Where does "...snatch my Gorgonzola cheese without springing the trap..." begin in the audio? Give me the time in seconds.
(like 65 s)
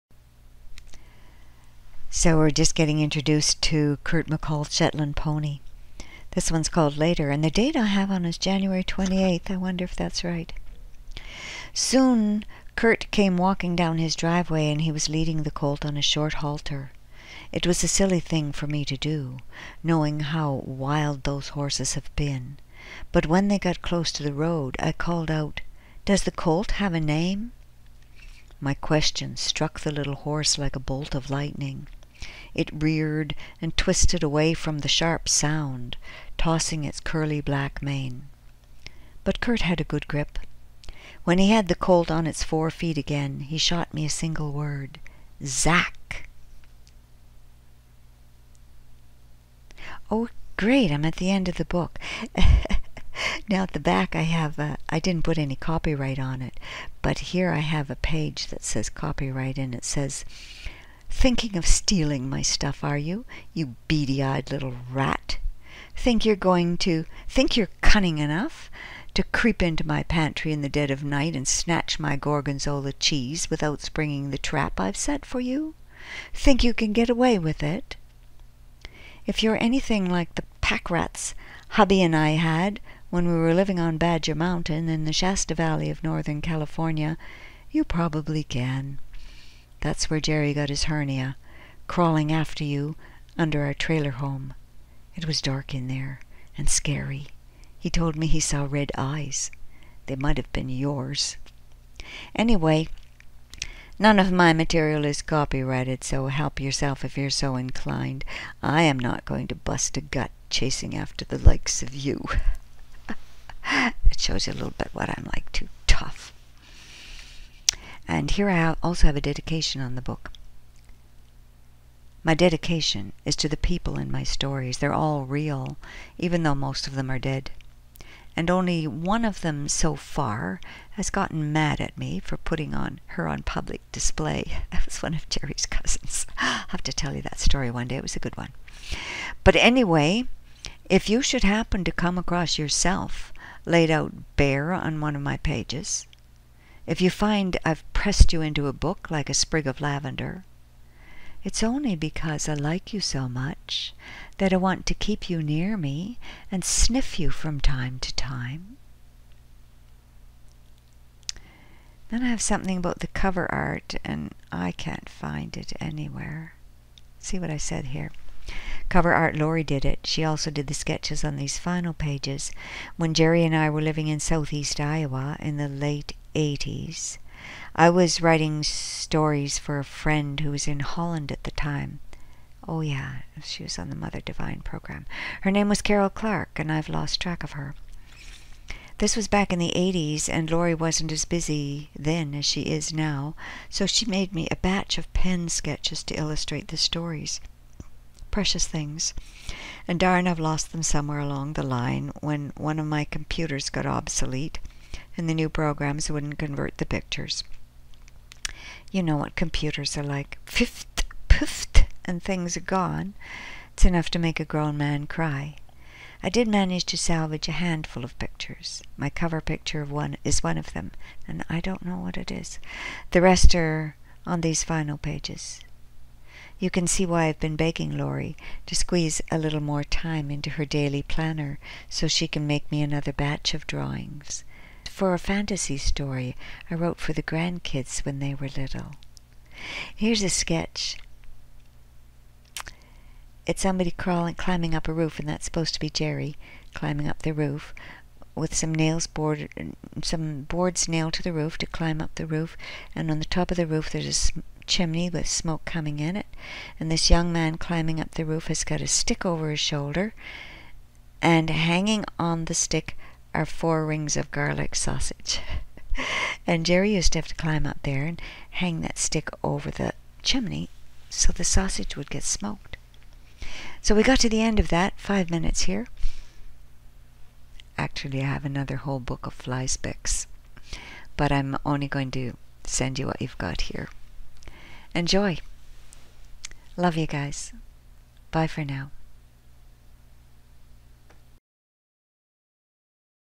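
71 s.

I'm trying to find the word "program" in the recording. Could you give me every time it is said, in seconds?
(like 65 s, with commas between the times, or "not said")
184 s, 205 s.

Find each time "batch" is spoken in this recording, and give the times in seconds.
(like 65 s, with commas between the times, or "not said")
194 s, 233 s.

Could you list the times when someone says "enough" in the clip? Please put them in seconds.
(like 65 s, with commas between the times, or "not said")
68 s, 213 s.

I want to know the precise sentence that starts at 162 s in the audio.
Then I have something about the cover art, and I can't find it anywhere.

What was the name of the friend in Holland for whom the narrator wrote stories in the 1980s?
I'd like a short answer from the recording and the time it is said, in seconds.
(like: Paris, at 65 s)
Carol Clark, at 185 s.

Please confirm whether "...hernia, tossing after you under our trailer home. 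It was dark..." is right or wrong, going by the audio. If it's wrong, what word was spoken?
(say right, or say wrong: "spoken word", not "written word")
wrong: "crawling", not "tossing".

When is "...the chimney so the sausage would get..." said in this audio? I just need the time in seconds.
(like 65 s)
269 s.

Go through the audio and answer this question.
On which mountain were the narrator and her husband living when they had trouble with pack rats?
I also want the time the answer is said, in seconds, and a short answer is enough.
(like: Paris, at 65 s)
Badger Mountain, at 83 s.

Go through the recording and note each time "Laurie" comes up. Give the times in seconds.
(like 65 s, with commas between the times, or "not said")
169 s, 190 s, 227 s.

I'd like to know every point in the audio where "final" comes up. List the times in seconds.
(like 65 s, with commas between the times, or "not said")
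171 s, 224 s.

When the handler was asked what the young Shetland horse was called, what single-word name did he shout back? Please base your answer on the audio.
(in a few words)
Zack.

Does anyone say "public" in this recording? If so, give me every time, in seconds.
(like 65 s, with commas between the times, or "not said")
133 s.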